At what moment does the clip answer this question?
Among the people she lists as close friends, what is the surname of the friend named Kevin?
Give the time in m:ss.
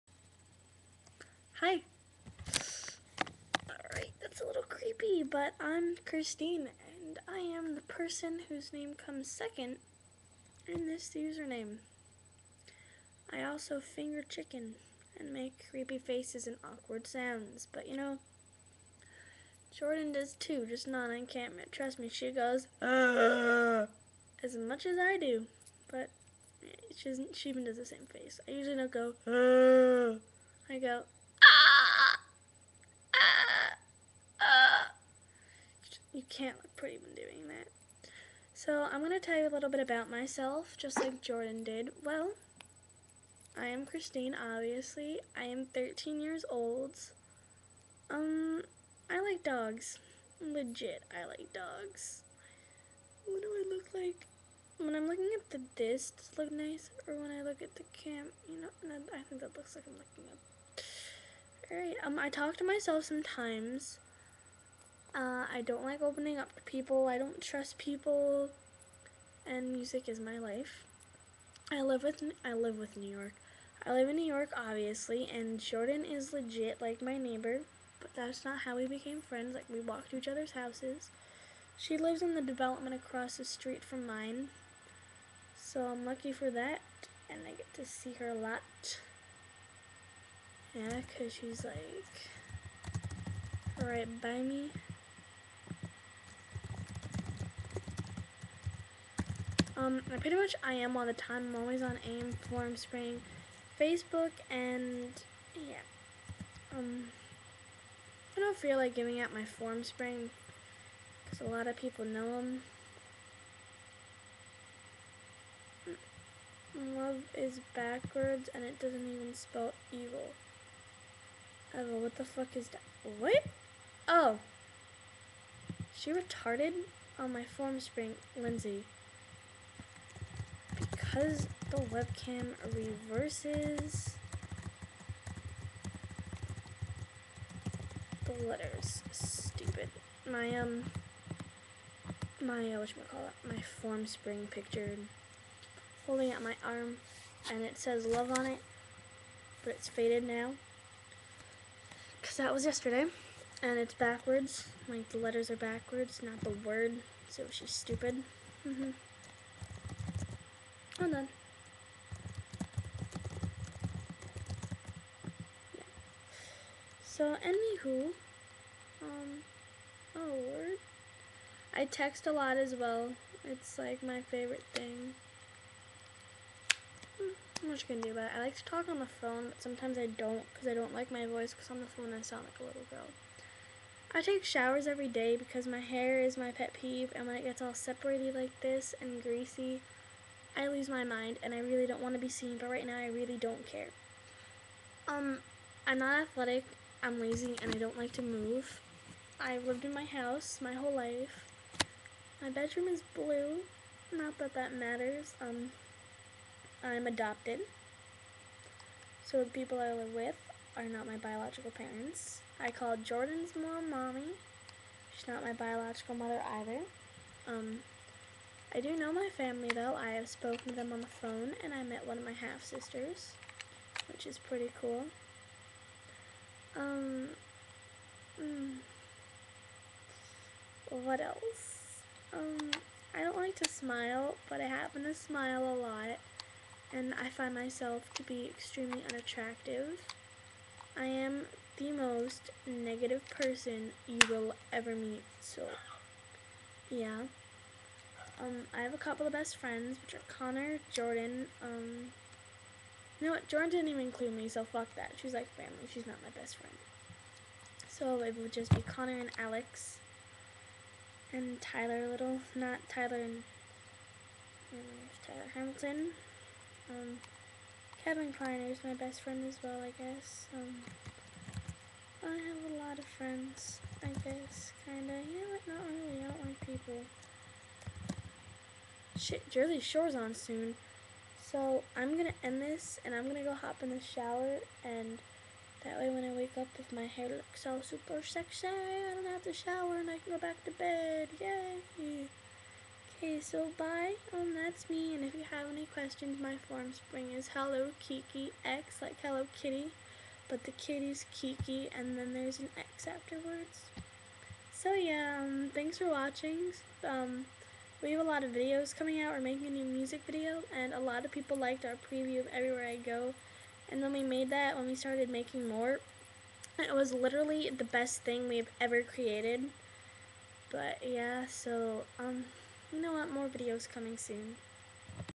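4:28.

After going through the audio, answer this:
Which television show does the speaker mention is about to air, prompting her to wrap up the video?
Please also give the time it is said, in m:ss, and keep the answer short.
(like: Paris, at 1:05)
Jersey Shore, at 4:39.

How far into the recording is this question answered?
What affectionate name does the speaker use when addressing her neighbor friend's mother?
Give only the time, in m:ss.
3:33.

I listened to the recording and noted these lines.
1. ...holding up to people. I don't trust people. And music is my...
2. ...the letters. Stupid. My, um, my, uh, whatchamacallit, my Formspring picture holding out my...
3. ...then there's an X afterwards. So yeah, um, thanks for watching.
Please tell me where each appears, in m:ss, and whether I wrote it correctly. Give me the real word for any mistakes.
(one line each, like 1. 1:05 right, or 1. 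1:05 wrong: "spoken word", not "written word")
1. 1:06 wrong: "opening", not "holding"
2. 2:18 right
3. 5:02 right.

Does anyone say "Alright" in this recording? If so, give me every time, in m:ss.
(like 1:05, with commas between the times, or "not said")
0:03, 1:01.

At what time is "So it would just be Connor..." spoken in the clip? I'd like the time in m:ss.
4:17.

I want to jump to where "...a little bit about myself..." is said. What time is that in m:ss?
0:39.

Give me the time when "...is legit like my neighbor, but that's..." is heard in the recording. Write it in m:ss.
1:16.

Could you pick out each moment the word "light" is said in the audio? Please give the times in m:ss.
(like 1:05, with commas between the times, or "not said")
not said.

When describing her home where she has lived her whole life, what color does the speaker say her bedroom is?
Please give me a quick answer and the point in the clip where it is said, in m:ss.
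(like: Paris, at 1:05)
Blue, at 3:23.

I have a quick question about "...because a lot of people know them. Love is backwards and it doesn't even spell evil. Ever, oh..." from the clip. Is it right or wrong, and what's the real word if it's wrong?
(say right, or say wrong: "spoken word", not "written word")
right.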